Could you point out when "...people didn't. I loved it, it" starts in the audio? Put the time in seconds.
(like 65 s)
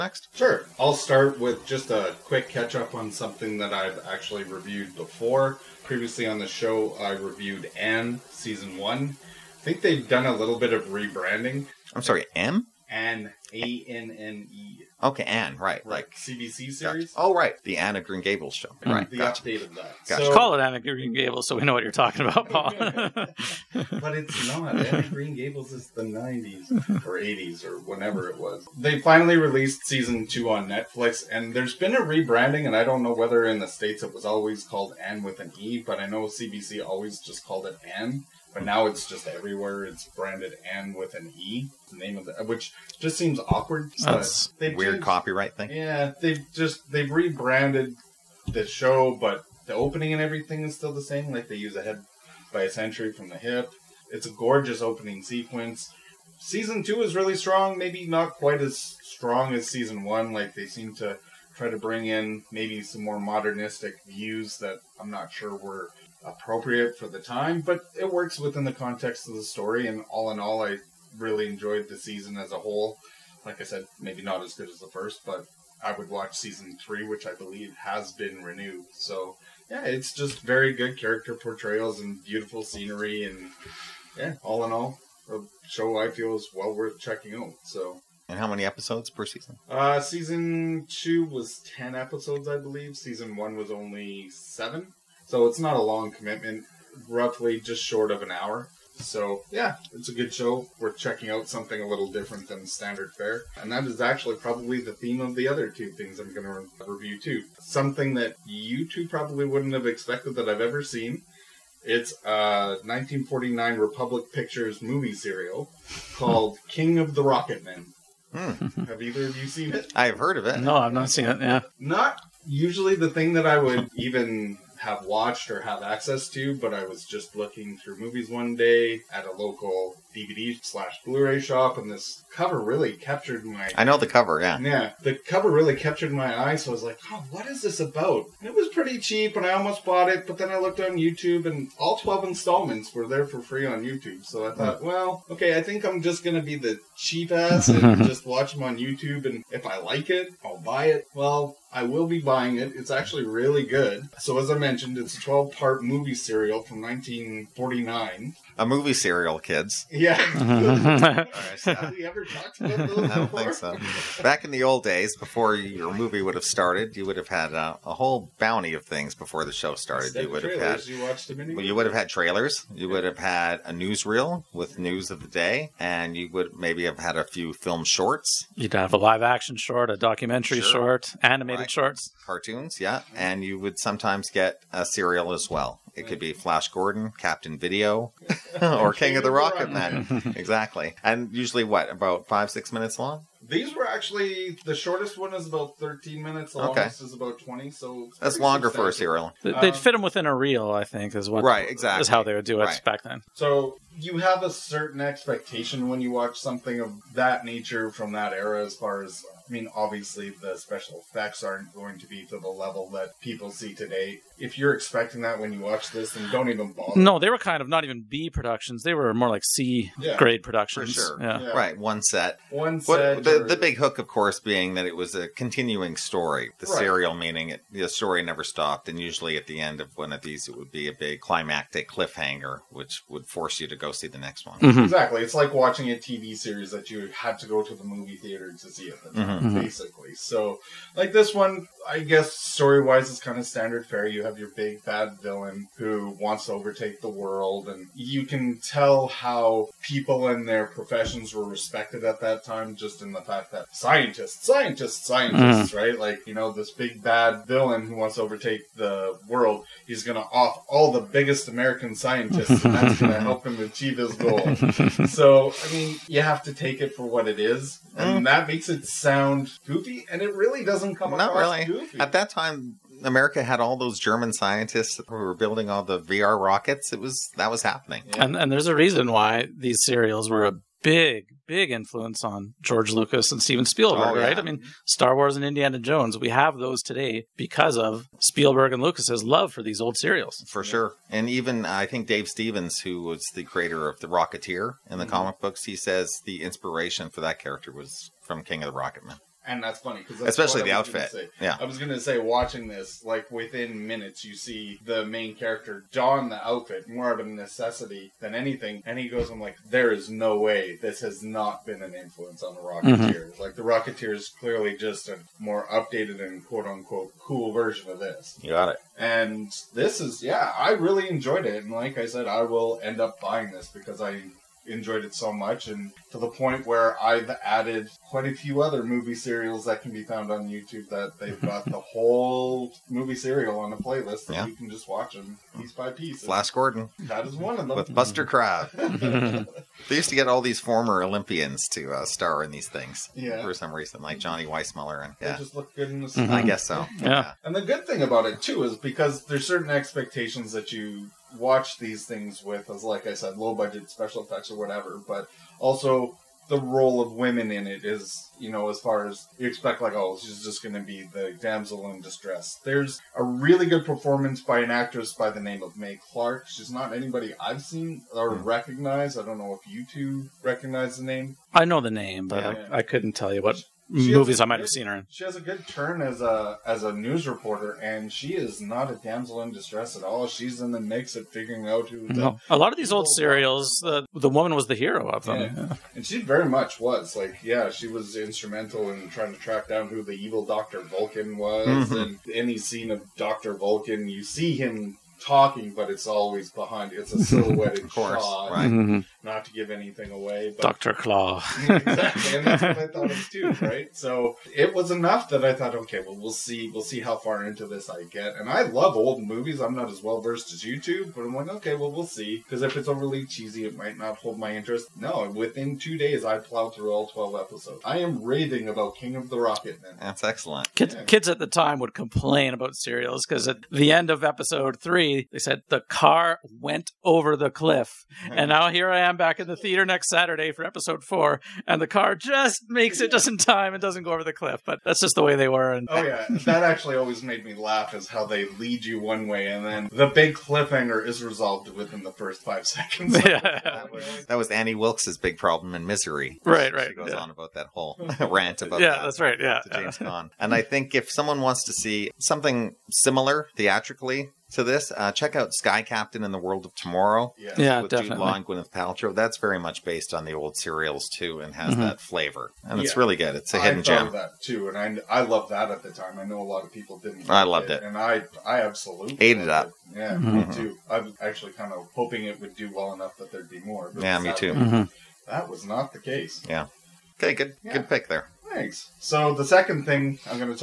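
466 s.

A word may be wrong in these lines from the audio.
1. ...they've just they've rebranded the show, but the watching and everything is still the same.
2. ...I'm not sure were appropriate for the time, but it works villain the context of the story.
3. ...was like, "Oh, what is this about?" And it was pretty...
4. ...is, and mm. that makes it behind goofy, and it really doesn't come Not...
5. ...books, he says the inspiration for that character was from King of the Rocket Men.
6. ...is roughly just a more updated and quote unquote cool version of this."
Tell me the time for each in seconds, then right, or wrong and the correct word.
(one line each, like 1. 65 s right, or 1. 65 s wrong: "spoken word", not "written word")
1. 46 s wrong: "opening", not "watching"
2. 64 s wrong: "within", not "villain"
3. 136 s right
4. 267 s wrong: "sound", not "behind"
5. 295 s right
6. 314 s wrong: "clearly", not "roughly".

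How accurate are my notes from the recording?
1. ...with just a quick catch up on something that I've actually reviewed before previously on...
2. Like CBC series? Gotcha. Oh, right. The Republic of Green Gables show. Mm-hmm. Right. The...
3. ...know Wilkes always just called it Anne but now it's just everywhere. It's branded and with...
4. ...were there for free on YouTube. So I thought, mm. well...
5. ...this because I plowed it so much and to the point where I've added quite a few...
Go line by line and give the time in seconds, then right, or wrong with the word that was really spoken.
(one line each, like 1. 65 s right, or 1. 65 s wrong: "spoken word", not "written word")
1. 1 s right
2. 15 s wrong: "Anne", not "Republic"
3. 36 s wrong: "CBC", not "Wilkes"
4. 142 s right
5. 323 s wrong: "enjoyed", not "plowed".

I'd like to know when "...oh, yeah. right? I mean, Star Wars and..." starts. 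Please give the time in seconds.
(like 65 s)
284 s.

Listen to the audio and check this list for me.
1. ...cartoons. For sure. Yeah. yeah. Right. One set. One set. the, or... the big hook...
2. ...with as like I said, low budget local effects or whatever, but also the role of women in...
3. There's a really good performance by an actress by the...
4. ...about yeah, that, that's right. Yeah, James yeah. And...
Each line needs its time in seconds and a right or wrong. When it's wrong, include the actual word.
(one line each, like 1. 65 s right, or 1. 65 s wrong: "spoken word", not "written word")
1. 220 s wrong: "productions", not "cartoons"
2. 352 s wrong: "special", not "local"
3. 362 s right
4. 448 s right.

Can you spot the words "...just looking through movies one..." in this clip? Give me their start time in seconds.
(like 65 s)
127 s.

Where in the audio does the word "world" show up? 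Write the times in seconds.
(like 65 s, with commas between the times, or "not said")
247 s, 259 s, 456 s.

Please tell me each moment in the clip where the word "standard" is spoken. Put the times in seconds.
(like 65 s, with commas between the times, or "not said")
102 s, 243 s.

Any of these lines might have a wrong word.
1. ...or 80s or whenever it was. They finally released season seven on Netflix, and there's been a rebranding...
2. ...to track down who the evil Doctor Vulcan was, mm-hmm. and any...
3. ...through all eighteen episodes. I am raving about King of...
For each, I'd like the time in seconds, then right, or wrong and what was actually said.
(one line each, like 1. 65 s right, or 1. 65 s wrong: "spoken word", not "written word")
1. 27 s wrong: "two", not "seven"
2. 389 s right
3. 416 s wrong: "twelve", not "eighteen".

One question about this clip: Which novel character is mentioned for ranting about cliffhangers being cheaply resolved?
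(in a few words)
Annie Wilkes.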